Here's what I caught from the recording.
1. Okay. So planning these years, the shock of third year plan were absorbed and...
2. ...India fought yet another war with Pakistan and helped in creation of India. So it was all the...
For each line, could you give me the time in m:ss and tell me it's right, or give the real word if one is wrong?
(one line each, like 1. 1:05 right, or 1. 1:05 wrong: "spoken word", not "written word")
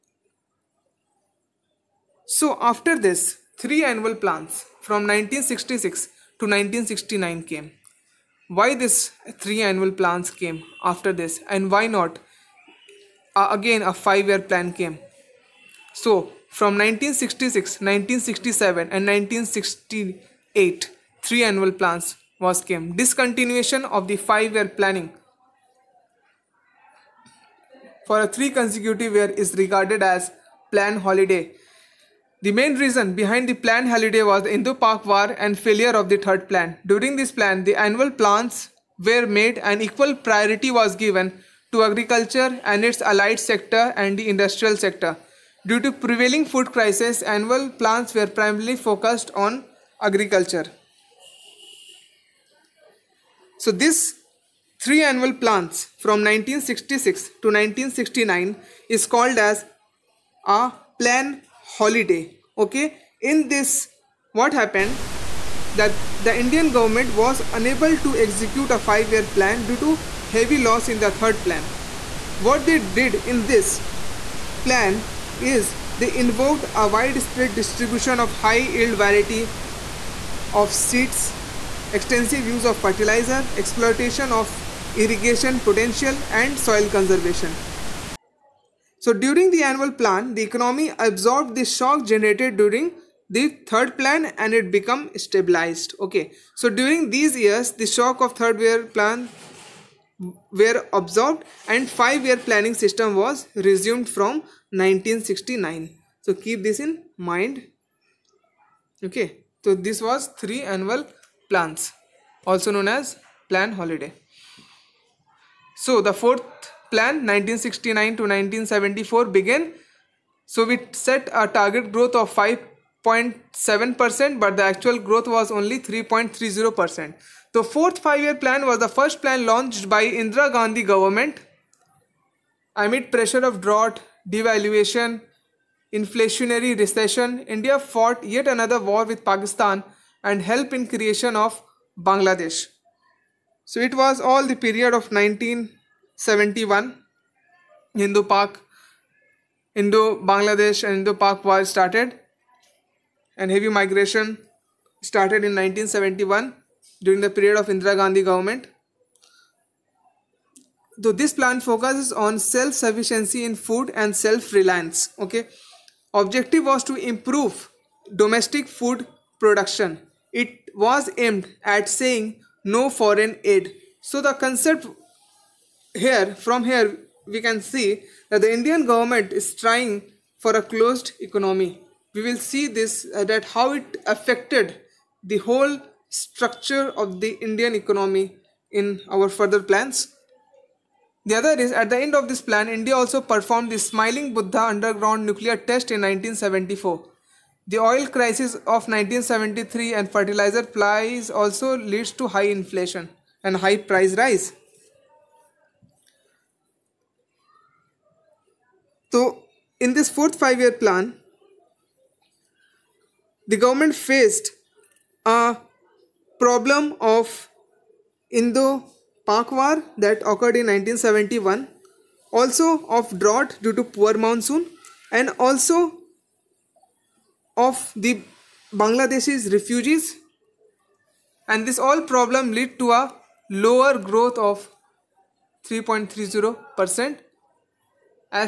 1. 1:35 wrong: "during", not "planning"
2. 2:17 wrong: "Bangladesh", not "India".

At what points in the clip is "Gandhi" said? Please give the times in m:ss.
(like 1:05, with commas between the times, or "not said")
2:10, 2:37.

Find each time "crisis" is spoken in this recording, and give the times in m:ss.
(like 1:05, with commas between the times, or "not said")
0:46, 3:18.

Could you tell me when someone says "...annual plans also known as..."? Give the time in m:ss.
1:50.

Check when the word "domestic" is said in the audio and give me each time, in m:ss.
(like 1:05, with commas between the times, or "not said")
2:48.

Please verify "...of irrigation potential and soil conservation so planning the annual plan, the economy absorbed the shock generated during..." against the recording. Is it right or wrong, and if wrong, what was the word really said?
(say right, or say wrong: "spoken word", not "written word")
wrong: "during", not "planning".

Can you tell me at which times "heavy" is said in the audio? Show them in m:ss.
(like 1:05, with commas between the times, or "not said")
1:10, 2:33.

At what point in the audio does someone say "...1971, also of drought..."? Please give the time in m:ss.
3:40.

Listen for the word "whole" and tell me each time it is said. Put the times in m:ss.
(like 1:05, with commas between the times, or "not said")
3:05.